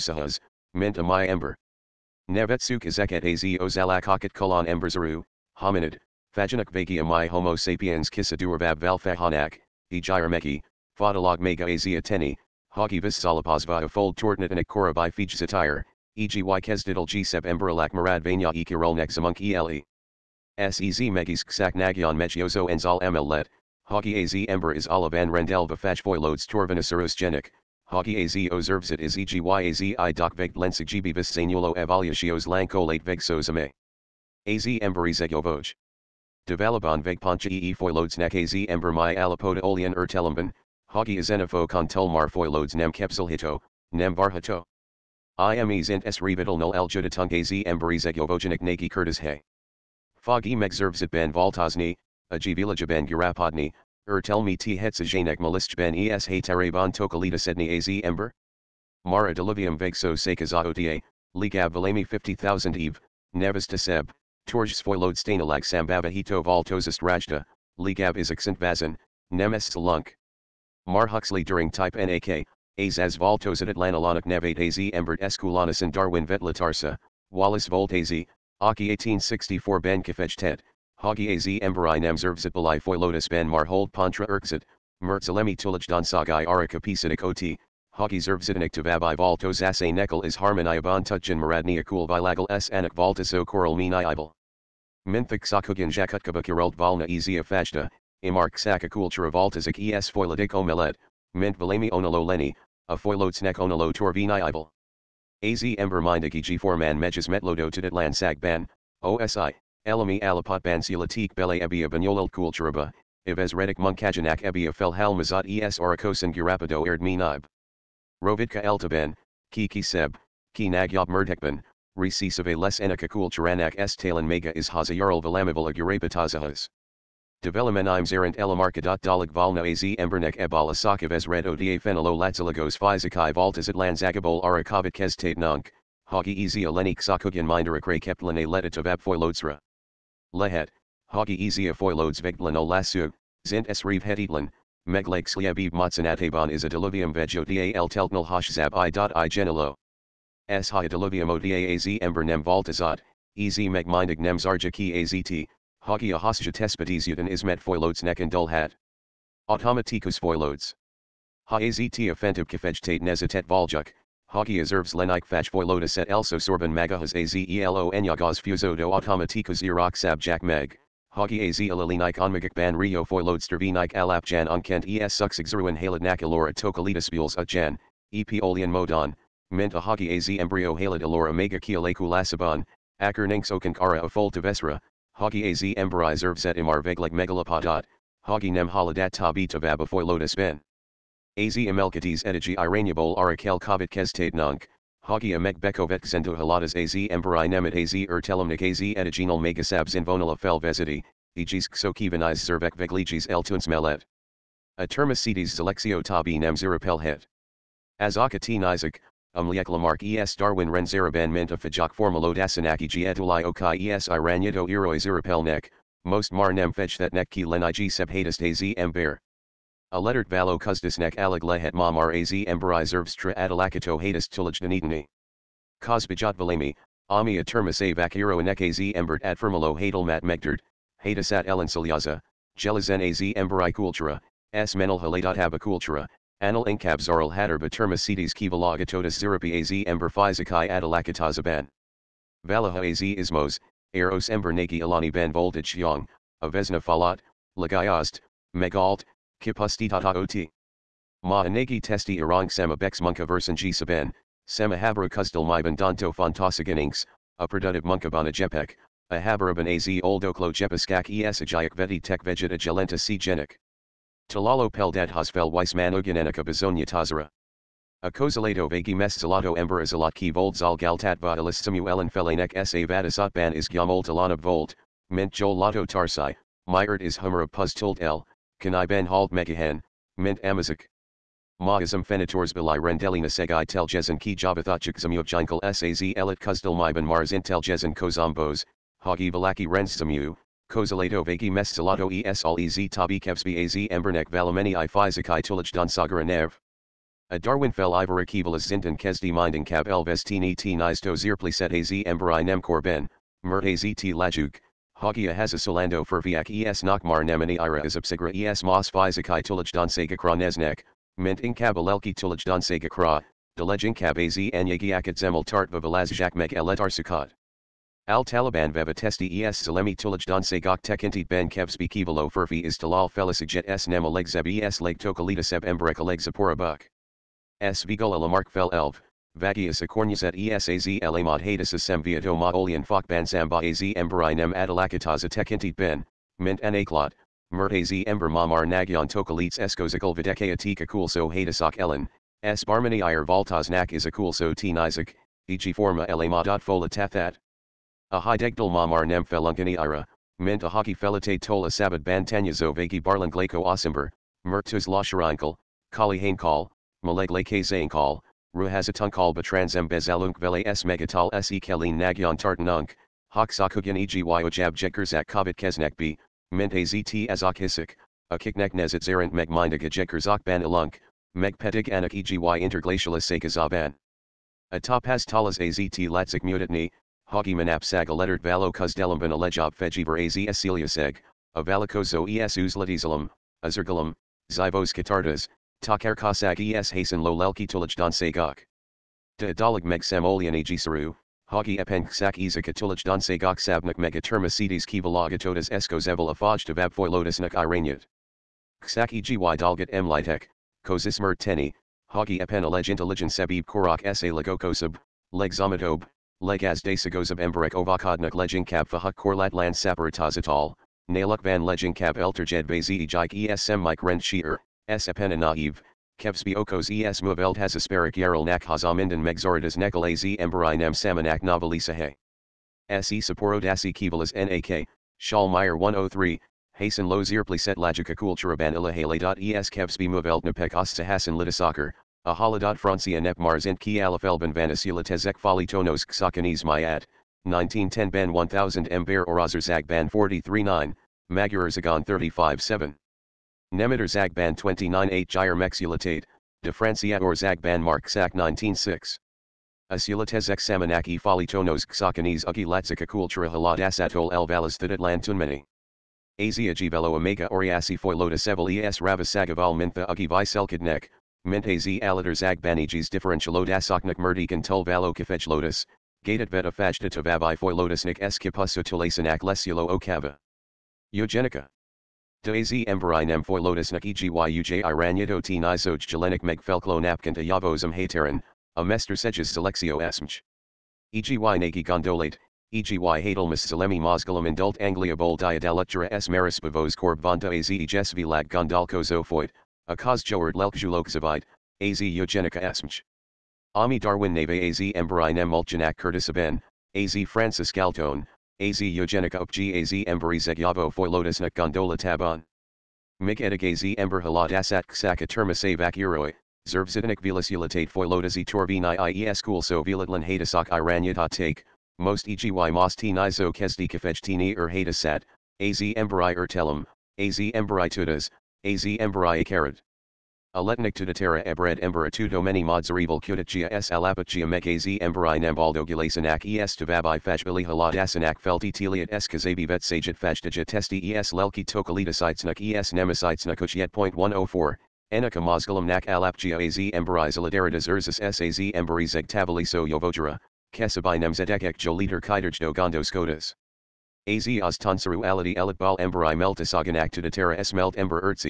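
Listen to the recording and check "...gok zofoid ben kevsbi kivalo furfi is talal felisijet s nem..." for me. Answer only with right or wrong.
wrong.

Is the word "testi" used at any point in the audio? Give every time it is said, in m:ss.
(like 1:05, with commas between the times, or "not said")
4:11, 5:18, 8:50.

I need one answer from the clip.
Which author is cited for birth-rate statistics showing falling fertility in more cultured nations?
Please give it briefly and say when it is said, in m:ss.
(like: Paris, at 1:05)
Schallmayer, at 7:05.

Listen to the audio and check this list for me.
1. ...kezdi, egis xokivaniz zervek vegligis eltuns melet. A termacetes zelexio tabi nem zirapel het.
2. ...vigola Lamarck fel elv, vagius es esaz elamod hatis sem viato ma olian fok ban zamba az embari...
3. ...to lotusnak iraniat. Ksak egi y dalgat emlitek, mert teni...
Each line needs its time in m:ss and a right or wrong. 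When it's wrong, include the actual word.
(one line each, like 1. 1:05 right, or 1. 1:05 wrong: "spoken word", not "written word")
1. 3:20 wrong: "vezidi", not "kezdi"
2. 5:27 right
3. 6:36 right.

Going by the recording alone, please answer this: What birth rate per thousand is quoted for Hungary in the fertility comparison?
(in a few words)
35.7.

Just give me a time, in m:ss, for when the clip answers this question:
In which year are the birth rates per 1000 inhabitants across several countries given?
7:17.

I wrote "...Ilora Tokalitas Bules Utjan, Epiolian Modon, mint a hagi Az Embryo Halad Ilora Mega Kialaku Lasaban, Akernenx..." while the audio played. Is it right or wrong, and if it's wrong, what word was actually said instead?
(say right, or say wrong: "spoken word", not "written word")
right.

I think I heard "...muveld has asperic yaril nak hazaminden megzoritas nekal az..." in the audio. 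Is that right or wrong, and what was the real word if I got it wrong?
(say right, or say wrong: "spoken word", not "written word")
right.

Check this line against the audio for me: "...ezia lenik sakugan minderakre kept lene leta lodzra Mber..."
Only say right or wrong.
wrong.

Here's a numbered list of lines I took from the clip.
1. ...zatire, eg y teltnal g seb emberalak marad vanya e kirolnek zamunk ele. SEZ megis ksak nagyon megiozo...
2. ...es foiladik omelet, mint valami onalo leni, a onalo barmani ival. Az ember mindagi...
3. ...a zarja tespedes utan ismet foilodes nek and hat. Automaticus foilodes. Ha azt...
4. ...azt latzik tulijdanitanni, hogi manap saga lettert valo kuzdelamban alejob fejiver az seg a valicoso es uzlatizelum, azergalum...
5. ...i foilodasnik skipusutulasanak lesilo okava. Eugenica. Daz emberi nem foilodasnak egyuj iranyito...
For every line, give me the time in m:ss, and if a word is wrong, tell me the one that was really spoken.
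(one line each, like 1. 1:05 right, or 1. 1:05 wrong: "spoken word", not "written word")
1. 0:15 wrong: "kesdidal", not "teltnal"
2. 1:39 wrong: "torvini", not "barmani"
3. 2:36 wrong: "hosja", not "zarja"
4. 6:15 wrong: "mutatni", not "tulijdanitanni"
5. 7:47 right.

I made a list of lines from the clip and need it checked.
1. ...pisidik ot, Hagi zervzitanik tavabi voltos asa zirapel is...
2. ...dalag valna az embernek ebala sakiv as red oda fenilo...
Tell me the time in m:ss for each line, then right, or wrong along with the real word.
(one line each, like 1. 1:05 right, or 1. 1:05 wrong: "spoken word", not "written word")
1. 1:26 wrong: "nekel", not "zirapel"
2. 2:09 right.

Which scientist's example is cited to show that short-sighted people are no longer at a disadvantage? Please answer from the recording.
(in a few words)
Weismann.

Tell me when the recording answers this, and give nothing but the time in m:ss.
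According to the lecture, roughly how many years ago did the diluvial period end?
1:02.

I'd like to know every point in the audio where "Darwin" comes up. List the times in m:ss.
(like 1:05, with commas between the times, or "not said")
1:15, 3:30, 4:57, 8:13.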